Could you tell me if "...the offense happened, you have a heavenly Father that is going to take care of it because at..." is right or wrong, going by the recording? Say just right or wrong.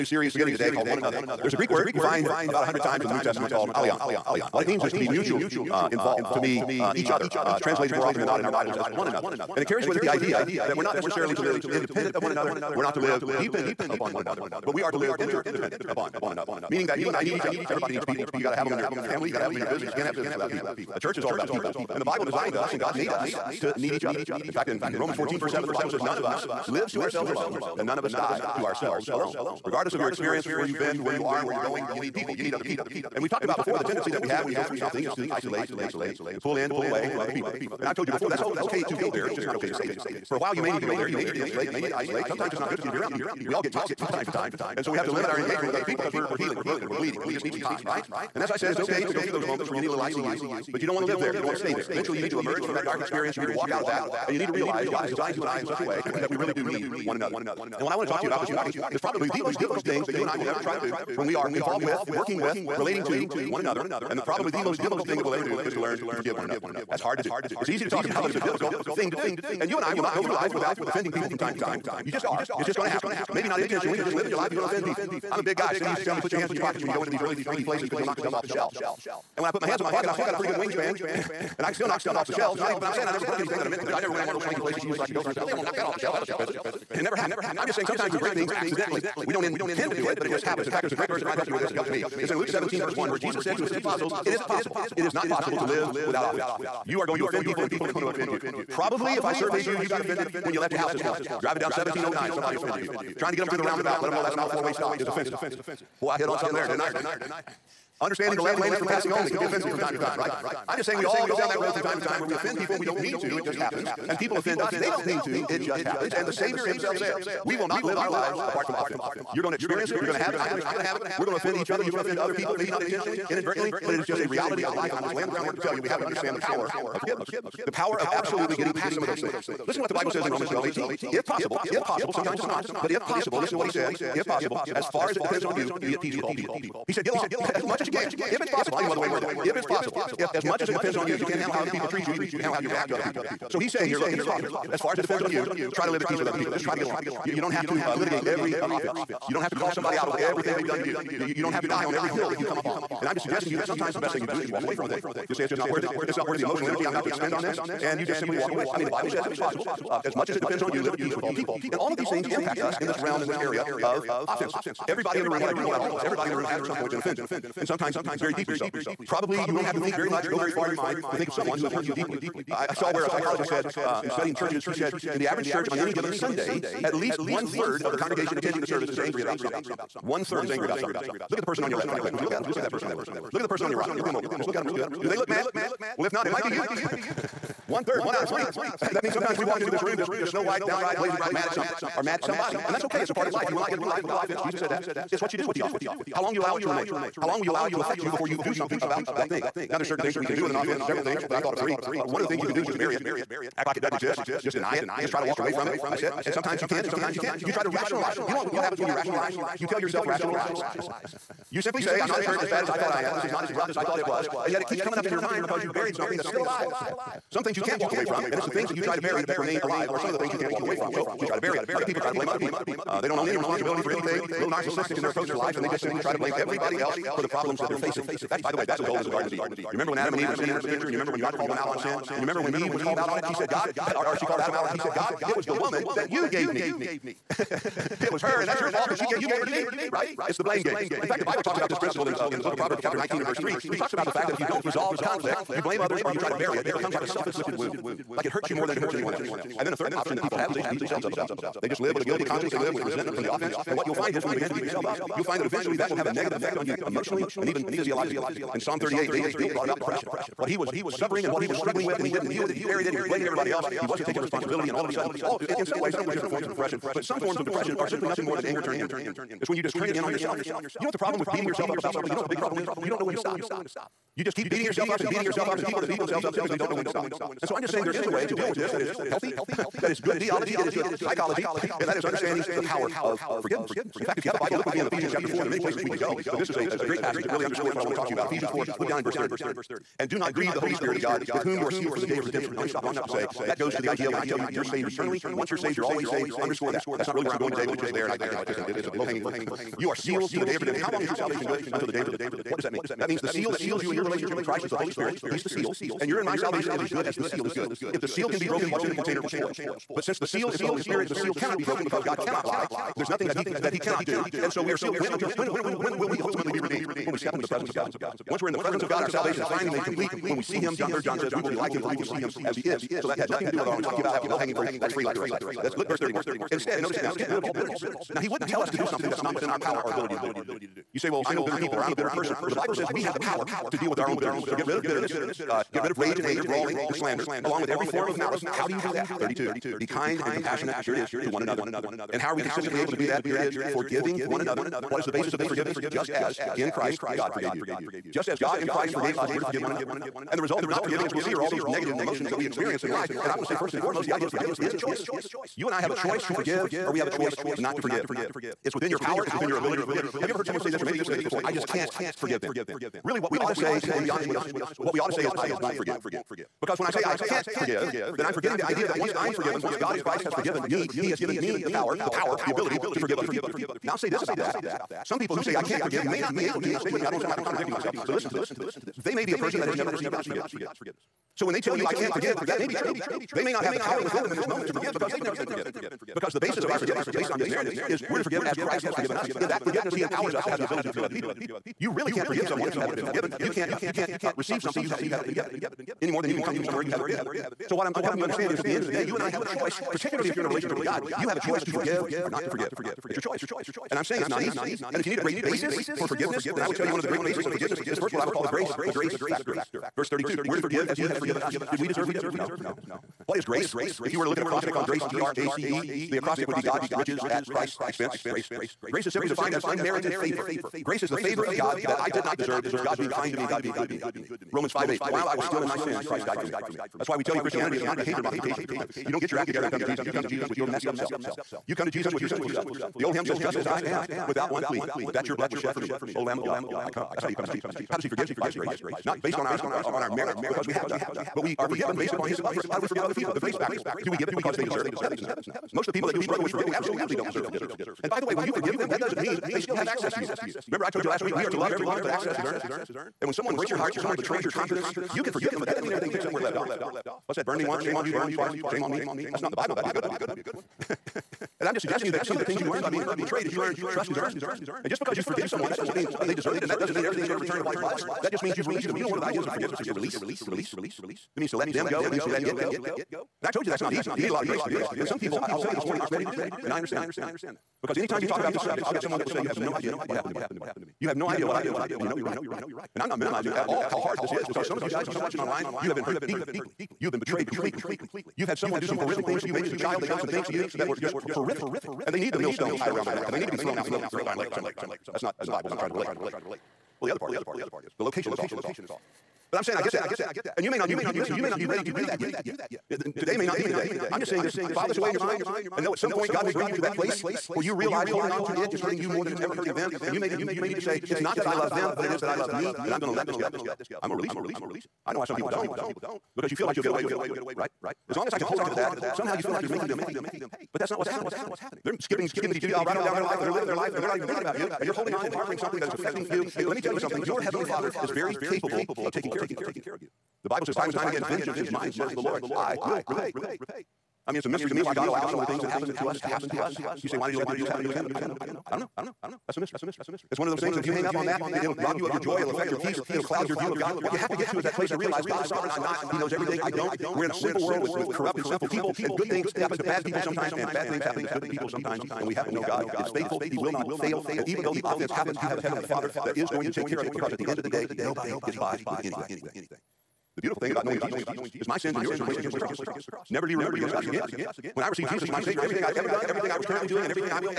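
right.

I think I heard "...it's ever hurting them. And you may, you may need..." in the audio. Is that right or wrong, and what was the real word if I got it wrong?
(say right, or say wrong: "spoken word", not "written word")
right.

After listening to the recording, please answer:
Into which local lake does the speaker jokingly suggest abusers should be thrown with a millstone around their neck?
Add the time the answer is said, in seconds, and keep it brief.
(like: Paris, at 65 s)
Grapevine Lake, at 494 s.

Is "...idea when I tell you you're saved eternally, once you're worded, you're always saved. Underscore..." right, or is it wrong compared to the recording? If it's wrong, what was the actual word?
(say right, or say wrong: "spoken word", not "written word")
wrong: "saved", not "worded".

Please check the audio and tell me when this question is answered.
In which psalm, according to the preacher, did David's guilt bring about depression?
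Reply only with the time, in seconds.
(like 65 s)
258 s.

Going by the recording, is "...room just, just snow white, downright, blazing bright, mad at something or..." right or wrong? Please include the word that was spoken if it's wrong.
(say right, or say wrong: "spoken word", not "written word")
right.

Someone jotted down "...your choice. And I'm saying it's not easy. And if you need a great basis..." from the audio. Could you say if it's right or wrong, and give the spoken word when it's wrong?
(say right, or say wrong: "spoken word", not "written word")
right.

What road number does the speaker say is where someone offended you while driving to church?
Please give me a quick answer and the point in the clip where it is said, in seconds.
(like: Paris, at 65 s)
1709, at 101 s.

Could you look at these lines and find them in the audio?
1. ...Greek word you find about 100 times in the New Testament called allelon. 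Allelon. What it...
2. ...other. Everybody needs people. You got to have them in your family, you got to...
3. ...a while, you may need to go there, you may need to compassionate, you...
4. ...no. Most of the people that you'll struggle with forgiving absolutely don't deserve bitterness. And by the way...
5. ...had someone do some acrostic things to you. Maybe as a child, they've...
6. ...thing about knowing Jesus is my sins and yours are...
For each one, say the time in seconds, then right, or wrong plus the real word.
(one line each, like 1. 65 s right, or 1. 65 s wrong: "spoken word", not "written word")
1. 1 s right
2. 17 s right
3. 40 s wrong: "insulate", not "compassionate"
4. 445 s wrong: "forgiveness", not "bitterness"
5. 488 s wrong: "horrific", not "acrostic"
6. 560 s right.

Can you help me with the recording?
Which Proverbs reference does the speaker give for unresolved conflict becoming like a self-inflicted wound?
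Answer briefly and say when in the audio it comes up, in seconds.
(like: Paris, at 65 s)
Proverbs 19:3, at 242 s.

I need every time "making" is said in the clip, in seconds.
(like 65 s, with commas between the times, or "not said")
519 s.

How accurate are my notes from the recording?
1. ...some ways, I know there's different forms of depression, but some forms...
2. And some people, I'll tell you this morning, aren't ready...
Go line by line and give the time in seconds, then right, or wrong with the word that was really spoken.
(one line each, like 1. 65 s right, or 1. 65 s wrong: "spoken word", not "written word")
1. 265 s right
2. 474 s right.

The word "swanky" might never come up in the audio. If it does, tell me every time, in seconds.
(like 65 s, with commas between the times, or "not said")
77 s, 84 s.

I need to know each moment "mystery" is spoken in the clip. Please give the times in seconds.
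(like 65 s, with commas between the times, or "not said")
534 s, 539 s.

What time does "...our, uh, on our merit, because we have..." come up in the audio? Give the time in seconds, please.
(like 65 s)
439 s.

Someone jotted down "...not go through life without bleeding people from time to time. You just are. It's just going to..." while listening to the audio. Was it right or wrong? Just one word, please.
wrong.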